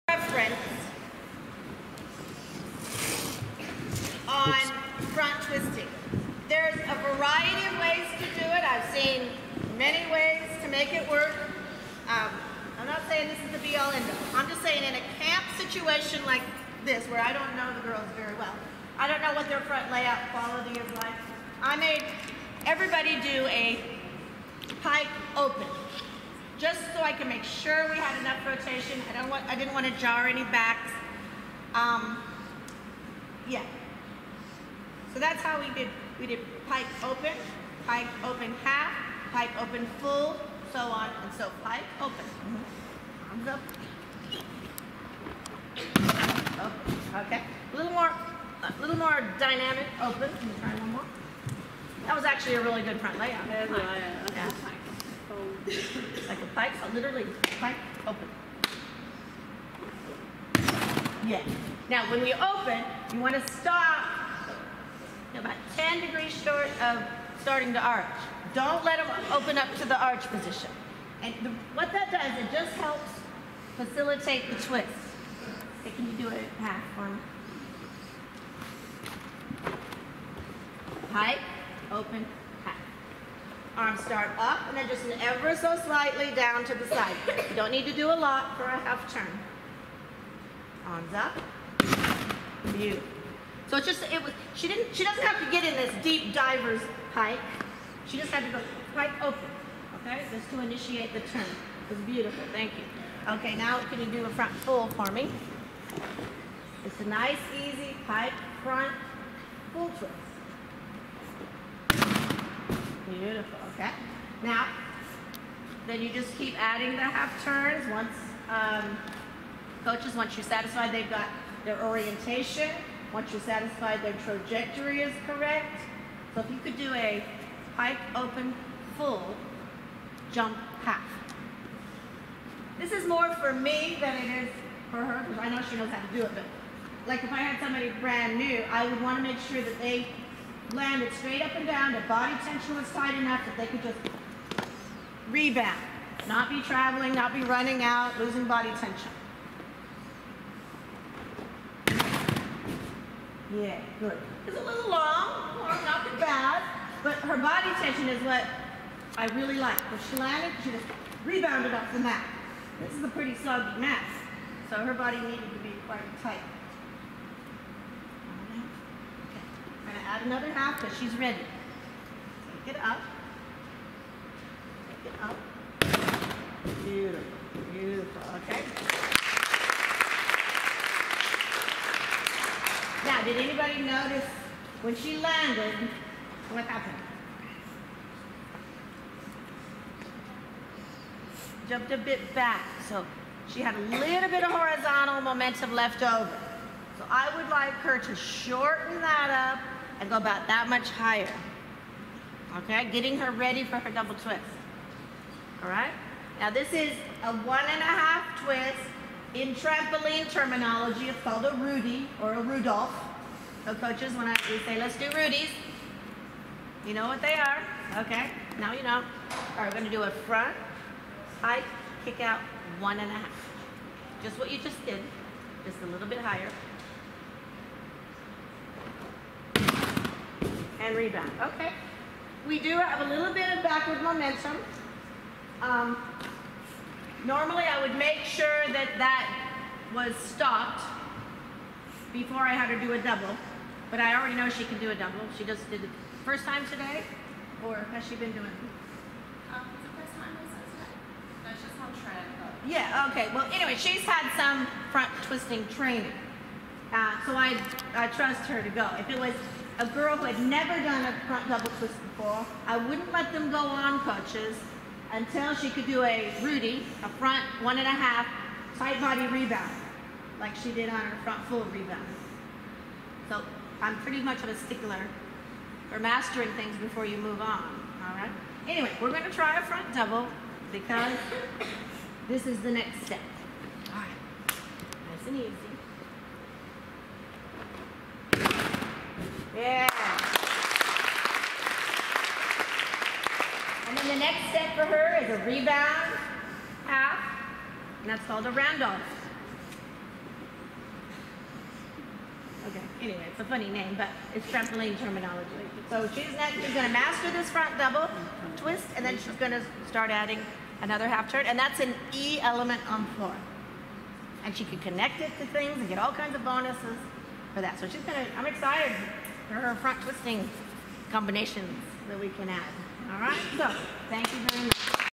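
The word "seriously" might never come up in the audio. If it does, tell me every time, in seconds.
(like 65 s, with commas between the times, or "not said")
not said.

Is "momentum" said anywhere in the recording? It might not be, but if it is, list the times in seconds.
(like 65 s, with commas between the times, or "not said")
195 s, 234 s.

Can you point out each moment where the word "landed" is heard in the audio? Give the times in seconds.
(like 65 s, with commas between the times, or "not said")
140 s, 185 s.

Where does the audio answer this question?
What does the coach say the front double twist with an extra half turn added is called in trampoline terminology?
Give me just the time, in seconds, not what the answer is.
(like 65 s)
298 s.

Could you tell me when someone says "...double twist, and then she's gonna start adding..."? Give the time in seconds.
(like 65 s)
307 s.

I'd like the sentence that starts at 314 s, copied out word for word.
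And she can connect it to things and get all kinds of bonuses for that.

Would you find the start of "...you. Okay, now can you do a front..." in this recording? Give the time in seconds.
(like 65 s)
102 s.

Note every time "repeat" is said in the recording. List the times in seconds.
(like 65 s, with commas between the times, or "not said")
not said.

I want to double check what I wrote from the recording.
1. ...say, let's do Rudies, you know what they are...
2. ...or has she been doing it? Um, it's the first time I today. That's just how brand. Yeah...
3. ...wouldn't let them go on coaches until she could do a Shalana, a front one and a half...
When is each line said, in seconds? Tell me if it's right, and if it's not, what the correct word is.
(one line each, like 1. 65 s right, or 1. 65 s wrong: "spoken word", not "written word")
1. 214 s right
2. 247 s wrong: "trend", not "brand"
3. 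262 s wrong: "Rudy", not "Shalana".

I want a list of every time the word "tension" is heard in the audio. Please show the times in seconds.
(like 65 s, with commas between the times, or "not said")
142 s, 148 s, 157 s.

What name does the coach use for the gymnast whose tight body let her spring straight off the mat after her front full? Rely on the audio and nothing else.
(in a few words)
Shalana.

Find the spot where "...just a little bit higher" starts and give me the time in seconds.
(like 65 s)
225 s.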